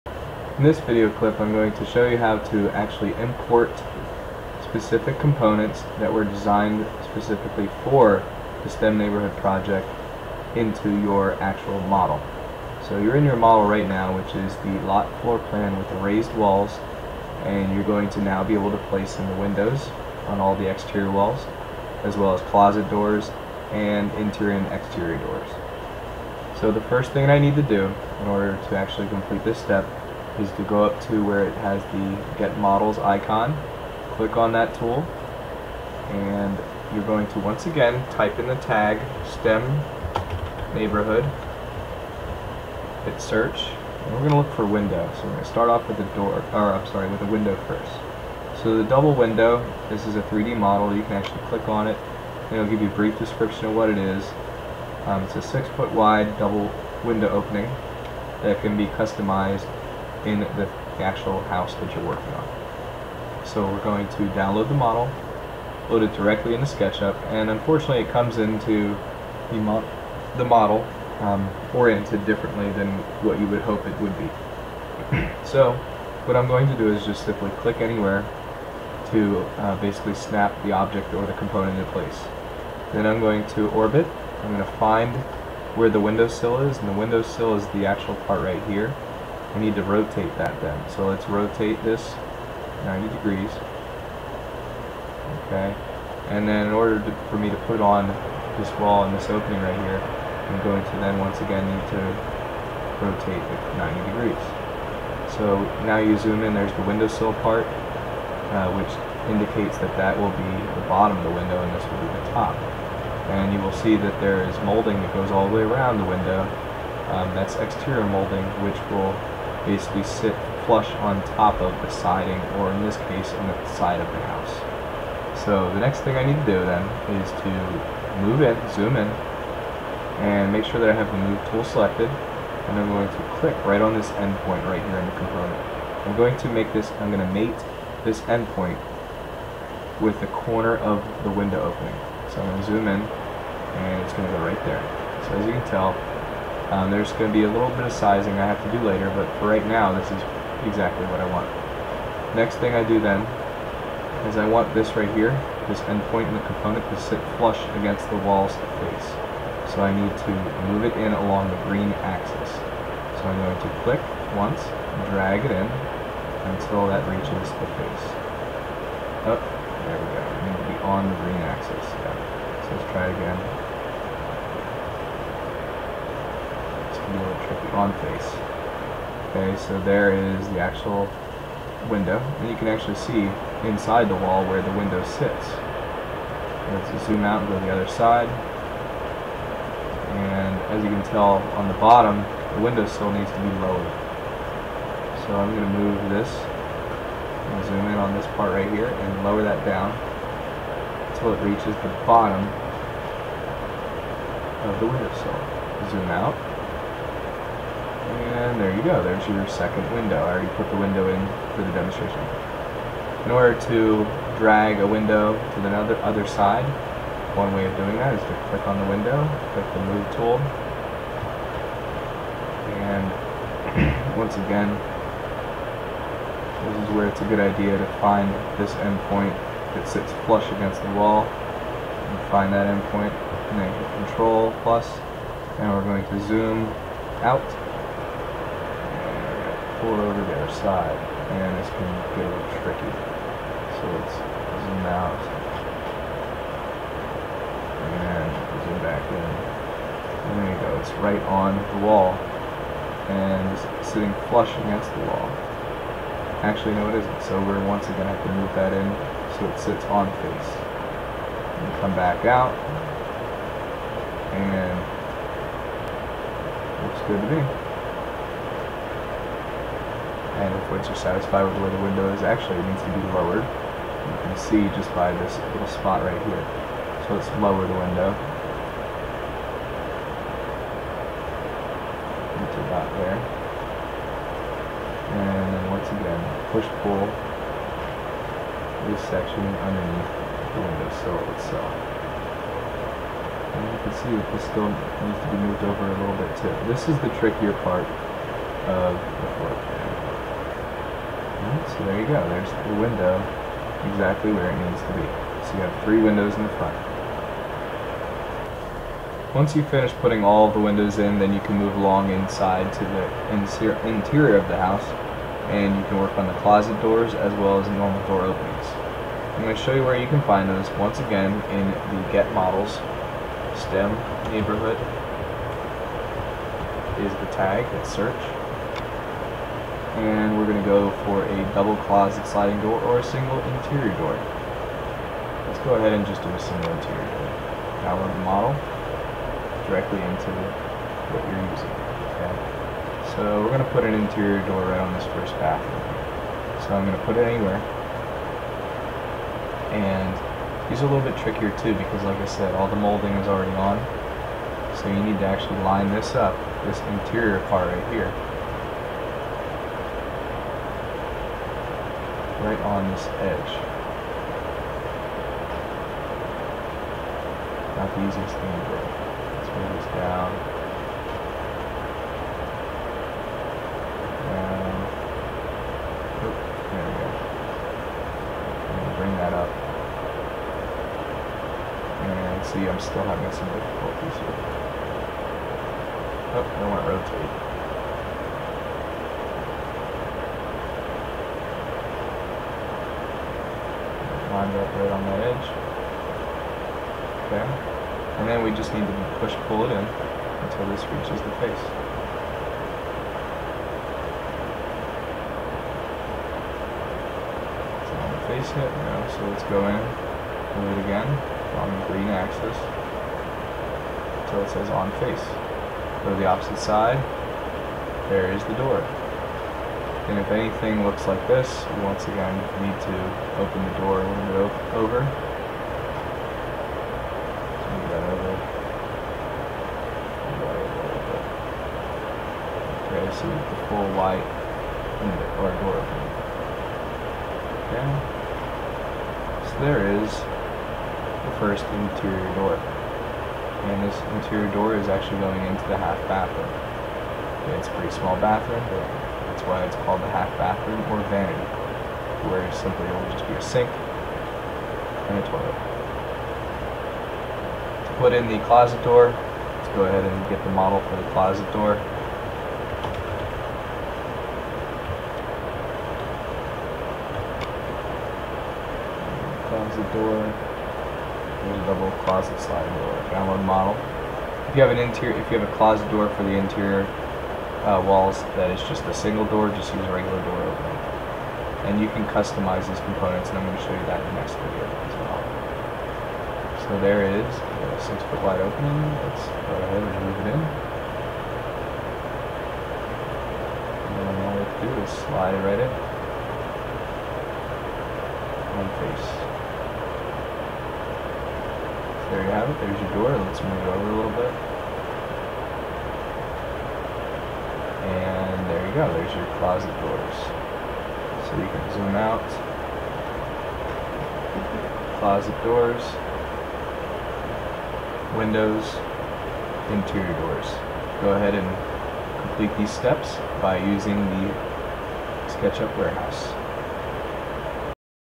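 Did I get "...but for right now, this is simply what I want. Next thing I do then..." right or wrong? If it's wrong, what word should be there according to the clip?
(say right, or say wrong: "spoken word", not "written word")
wrong: "exactly", not "simply".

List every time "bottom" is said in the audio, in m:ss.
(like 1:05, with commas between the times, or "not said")
1:50, 3:11, 3:22.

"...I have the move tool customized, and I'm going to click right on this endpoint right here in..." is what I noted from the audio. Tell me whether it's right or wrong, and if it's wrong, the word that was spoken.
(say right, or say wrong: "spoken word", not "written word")
wrong: "selected", not "customized".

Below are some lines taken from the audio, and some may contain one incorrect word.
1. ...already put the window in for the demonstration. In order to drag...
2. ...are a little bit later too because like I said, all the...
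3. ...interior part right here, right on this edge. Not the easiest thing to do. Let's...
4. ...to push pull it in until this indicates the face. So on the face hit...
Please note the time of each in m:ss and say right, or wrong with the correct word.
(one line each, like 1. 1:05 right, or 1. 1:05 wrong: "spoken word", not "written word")
1. 3:30 right
2. 5:50 wrong: "trickier", not "later"
3. 5:56 right
4. 6:38 wrong: "reaches", not "indicates".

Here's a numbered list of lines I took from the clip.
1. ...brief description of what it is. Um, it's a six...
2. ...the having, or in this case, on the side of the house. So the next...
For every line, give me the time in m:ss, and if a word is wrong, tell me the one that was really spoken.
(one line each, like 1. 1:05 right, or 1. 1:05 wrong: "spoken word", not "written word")
1. 0:52 right
2. 2:01 wrong: "siding", not "having".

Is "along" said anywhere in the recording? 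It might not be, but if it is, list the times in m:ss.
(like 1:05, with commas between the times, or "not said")
2:41, 5:11.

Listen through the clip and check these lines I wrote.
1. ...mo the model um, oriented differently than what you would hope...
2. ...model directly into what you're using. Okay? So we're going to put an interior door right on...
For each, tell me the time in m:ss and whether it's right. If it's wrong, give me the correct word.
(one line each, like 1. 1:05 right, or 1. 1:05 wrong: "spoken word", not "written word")
1. 1:09 right
2. 5:38 right.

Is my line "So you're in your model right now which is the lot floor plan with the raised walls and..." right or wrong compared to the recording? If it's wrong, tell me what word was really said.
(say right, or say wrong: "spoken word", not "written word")
right.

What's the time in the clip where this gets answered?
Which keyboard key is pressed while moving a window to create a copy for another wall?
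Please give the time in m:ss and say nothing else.
3:54.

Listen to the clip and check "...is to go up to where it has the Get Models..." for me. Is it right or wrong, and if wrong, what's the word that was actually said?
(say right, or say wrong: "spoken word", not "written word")
right.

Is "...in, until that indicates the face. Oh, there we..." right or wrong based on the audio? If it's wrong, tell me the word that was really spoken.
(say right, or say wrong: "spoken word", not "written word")
wrong: "reaches", not "indicates".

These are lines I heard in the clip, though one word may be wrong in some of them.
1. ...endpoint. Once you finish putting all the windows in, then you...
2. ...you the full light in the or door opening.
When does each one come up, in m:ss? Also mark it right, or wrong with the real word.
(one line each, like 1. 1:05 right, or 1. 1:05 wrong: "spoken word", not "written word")
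1. 5:06 wrong: "front", not "endpoint"
2. 7:13 right.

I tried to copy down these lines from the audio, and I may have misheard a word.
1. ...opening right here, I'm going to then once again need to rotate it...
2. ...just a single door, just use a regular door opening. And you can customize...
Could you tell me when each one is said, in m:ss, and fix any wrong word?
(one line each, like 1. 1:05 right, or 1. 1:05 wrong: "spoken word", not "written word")
1. 1:39 right
2. 7:58 right.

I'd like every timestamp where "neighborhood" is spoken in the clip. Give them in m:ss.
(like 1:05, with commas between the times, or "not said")
0:08, 0:40, 5:24.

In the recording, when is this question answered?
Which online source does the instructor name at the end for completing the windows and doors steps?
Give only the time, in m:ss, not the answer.
8:45.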